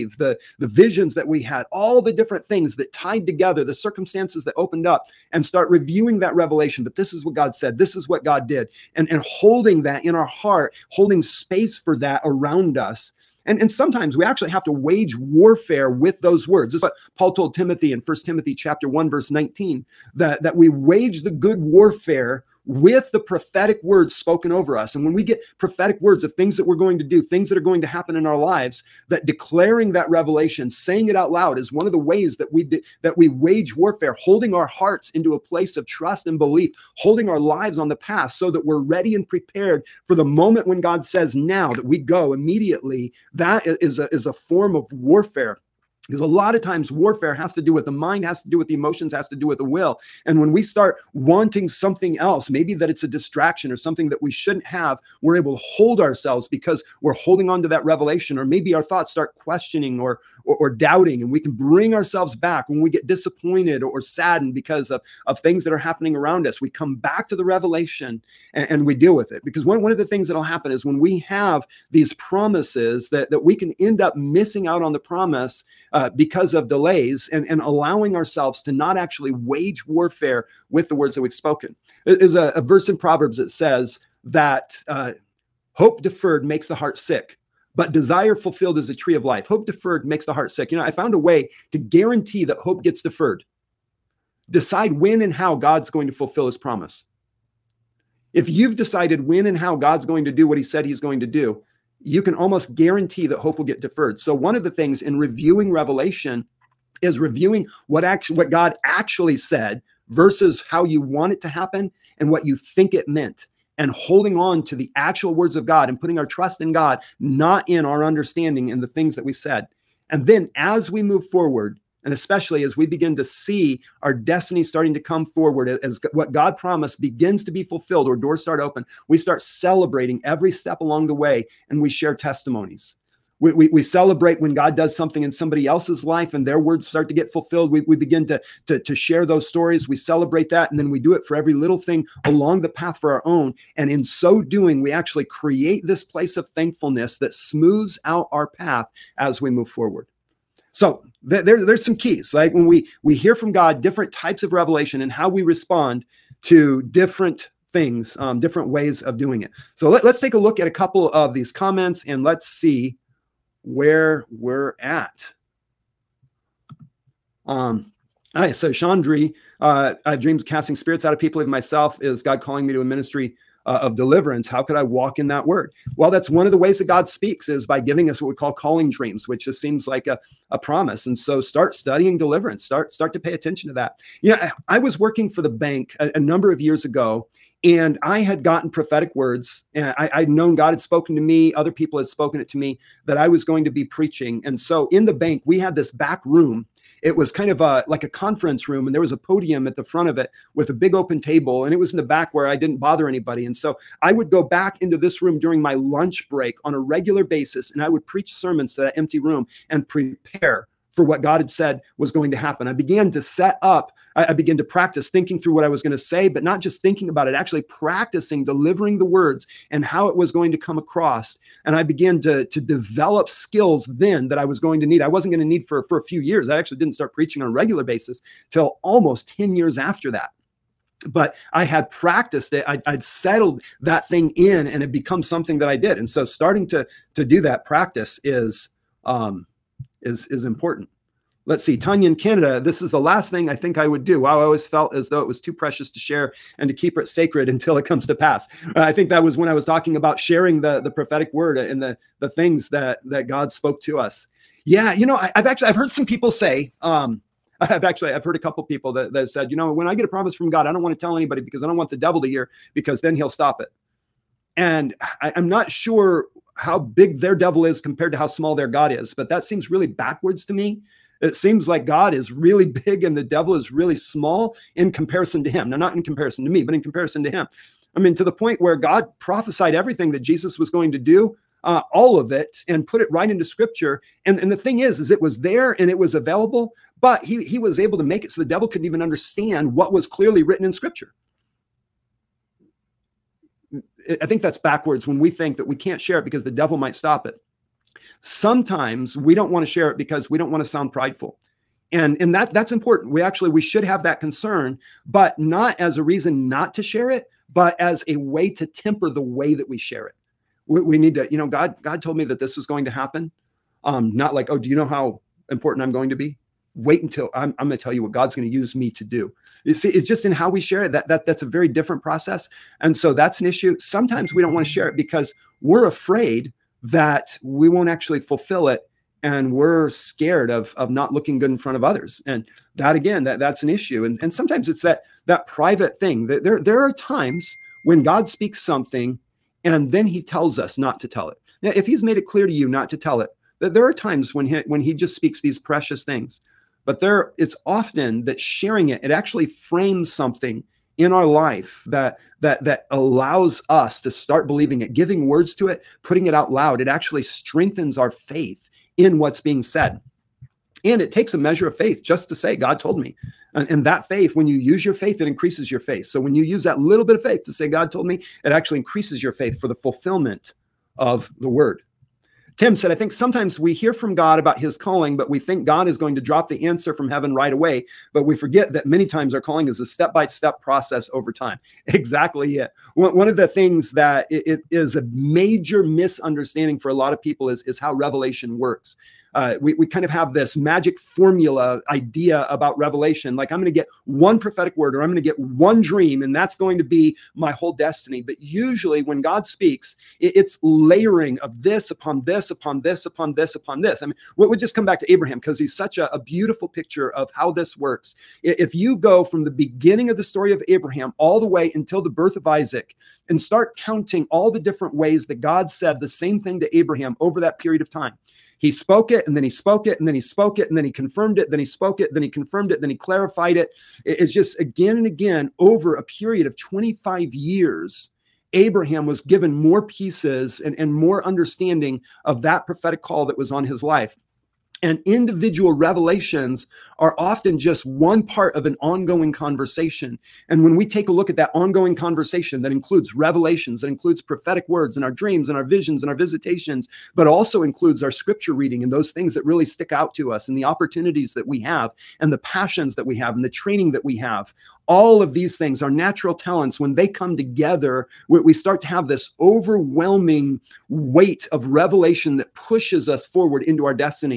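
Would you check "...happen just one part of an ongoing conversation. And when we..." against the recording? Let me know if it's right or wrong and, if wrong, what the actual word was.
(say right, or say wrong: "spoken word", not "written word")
wrong: "often", not "happen".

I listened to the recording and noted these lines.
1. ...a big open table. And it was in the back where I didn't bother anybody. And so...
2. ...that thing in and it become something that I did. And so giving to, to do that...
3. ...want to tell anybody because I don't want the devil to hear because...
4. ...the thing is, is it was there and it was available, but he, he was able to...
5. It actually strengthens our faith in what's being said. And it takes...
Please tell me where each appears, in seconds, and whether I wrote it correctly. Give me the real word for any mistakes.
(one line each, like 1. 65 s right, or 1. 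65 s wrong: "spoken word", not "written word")
1. 200 s right
2. 233 s wrong: "starting", not "giving"
3. 260 s right
4. 284 s right
5. 356 s right.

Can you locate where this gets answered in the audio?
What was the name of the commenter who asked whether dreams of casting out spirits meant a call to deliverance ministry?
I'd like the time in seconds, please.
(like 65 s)
168 s.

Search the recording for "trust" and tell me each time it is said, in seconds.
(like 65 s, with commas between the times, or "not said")
35 s, 116 s.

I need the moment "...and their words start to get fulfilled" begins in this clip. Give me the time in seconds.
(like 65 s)
136 s.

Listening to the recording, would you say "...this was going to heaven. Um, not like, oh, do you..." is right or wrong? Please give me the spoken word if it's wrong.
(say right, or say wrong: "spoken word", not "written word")
wrong: "happen", not "heaven".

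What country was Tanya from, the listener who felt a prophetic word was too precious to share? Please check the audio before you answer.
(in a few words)
Canada.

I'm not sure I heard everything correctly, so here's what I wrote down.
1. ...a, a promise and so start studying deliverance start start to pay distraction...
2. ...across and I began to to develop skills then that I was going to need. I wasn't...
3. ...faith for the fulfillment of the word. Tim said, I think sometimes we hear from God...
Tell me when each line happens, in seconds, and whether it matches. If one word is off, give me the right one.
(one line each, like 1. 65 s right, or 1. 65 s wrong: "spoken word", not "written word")
1. 180 s wrong: "attention", not "distraction"
2. 220 s right
3. 369 s right.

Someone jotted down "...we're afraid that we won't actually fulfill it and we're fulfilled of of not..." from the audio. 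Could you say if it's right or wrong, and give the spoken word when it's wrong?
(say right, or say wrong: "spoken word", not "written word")
wrong: "scared", not "fulfilled".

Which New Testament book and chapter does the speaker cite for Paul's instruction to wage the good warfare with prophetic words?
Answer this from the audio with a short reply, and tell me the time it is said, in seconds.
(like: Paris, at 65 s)
1 Timothy chapter 1, at 18 s.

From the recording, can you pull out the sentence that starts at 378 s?
But we forget that many times our calling is a step by step process over time.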